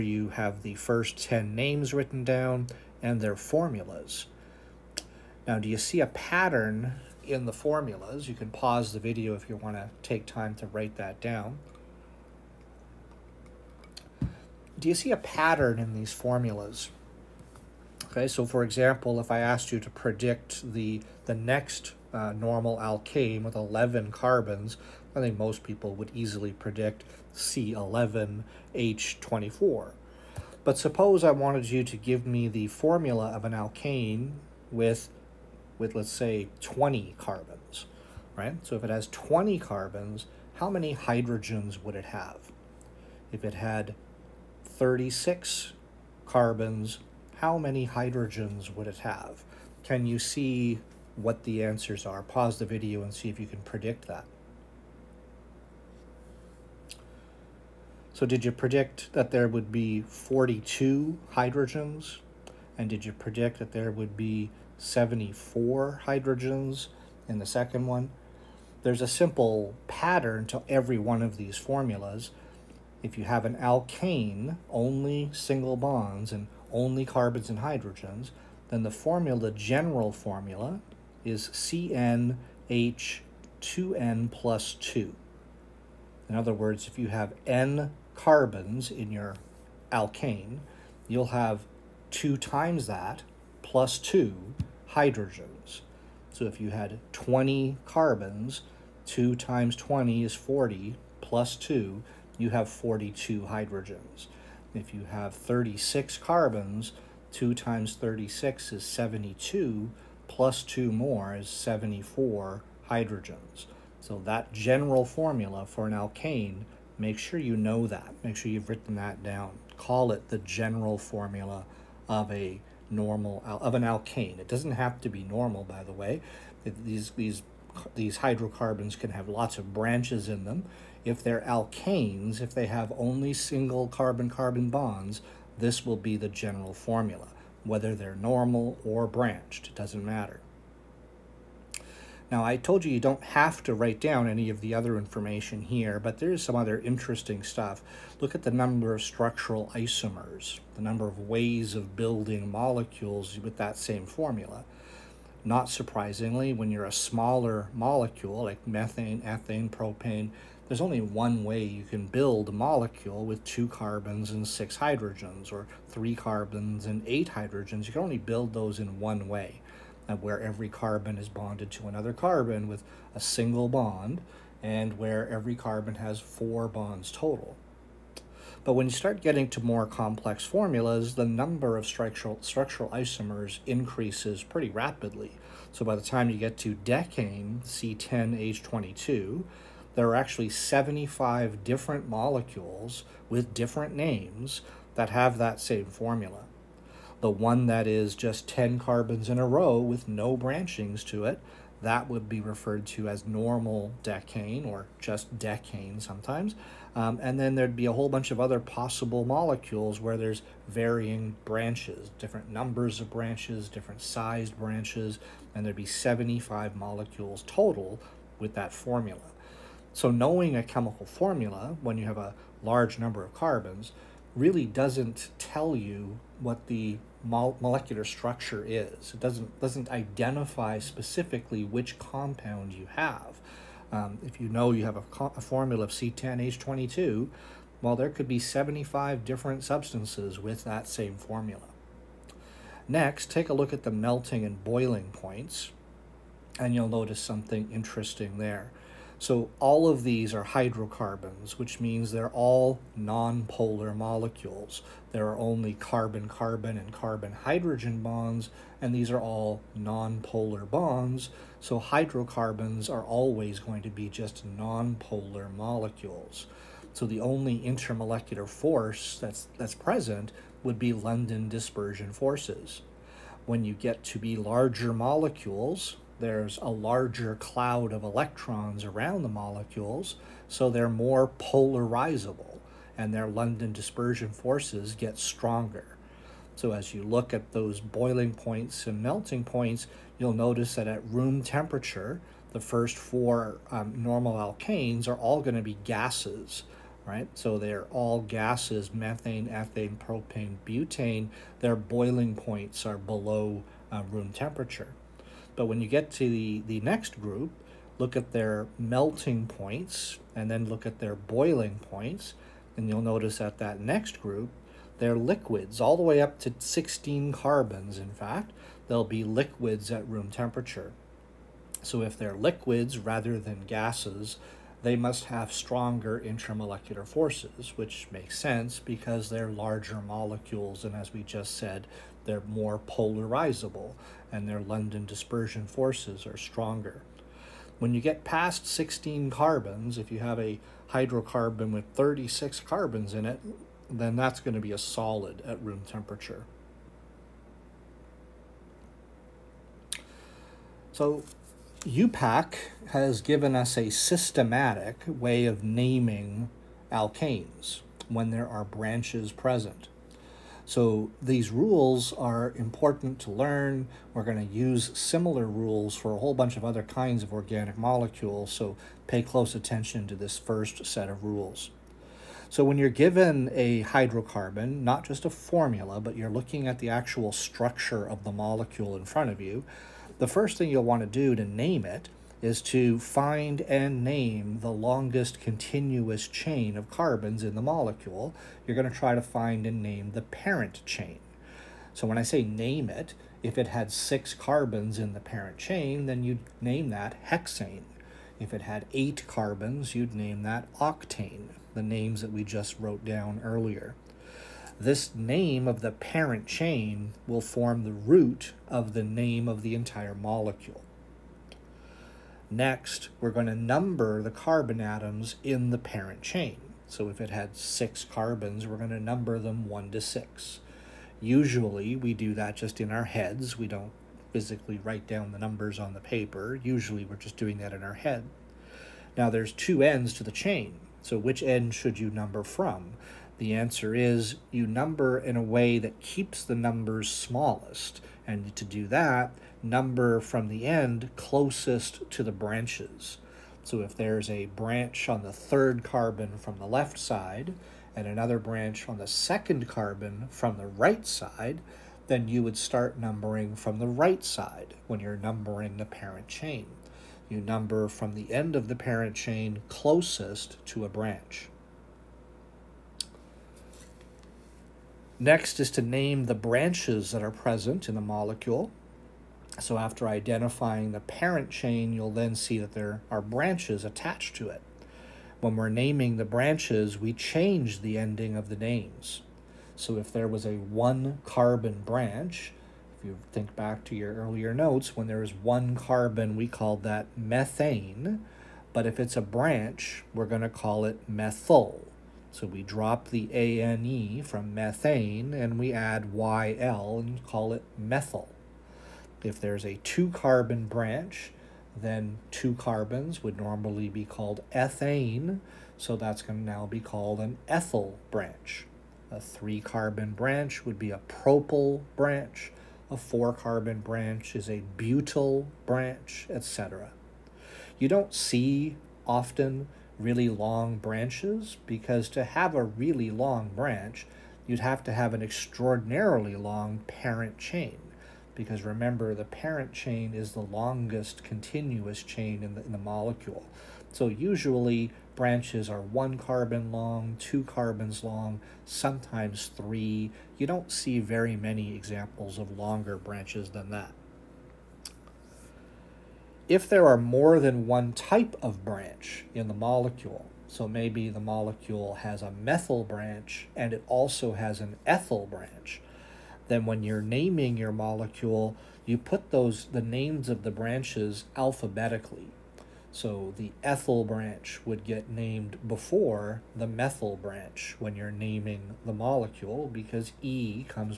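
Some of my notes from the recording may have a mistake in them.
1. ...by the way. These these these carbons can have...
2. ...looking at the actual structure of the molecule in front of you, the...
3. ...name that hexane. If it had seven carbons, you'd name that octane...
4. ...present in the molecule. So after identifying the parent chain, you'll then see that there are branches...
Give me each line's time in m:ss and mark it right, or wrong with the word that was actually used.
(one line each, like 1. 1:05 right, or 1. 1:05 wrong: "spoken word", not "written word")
1. 2:05 wrong: "hydrocarbons", not "carbons"
2. 6:16 right
3. 6:36 wrong: "eight", not "seven"
4. 7:47 right.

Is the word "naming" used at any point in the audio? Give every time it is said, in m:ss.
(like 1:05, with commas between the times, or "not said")
5:55, 7:55, 9:17, 9:28.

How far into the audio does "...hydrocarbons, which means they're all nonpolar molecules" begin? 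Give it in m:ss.
4:10.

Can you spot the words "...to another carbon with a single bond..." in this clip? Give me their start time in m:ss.
2:51.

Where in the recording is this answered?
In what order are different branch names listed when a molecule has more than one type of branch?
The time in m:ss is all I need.
9:21.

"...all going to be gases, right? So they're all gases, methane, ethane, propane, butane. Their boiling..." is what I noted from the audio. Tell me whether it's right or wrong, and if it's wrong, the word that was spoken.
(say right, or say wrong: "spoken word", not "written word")
right.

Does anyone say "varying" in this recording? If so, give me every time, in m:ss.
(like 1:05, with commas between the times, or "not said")
3:30.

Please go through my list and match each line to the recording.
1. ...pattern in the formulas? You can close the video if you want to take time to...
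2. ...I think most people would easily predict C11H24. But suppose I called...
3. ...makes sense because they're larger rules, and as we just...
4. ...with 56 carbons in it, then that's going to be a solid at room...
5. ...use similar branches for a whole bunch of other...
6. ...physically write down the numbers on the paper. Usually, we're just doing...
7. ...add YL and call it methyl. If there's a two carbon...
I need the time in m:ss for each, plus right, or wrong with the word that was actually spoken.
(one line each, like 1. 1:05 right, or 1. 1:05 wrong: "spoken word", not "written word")
1. 0:06 wrong: "pause", not "close"
2. 0:25 wrong: "wanted", not "called"
3. 5:28 wrong: "molecules", not "rules"
4. 5:41 wrong: "36", not "56"
5. 6:04 wrong: "rules", not "branches"
6. 7:04 right
7. 8:15 right.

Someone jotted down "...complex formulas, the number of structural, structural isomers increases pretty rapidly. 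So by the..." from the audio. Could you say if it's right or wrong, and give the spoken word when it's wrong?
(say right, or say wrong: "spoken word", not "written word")
right.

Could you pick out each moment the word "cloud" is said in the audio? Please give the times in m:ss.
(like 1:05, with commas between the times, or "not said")
4:37.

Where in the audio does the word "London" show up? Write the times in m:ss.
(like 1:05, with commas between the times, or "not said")
4:30, 4:43, 5:34.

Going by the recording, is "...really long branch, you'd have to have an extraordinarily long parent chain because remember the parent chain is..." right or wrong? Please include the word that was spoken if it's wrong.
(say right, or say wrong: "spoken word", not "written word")
right.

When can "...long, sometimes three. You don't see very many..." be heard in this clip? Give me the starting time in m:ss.
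8:58.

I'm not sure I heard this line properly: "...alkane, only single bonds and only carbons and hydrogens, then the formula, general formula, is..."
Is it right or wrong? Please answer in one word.
right.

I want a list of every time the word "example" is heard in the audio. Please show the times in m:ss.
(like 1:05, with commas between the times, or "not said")
0:18, 9:01.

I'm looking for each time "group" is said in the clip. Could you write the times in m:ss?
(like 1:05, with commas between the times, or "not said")
5:07, 5:14.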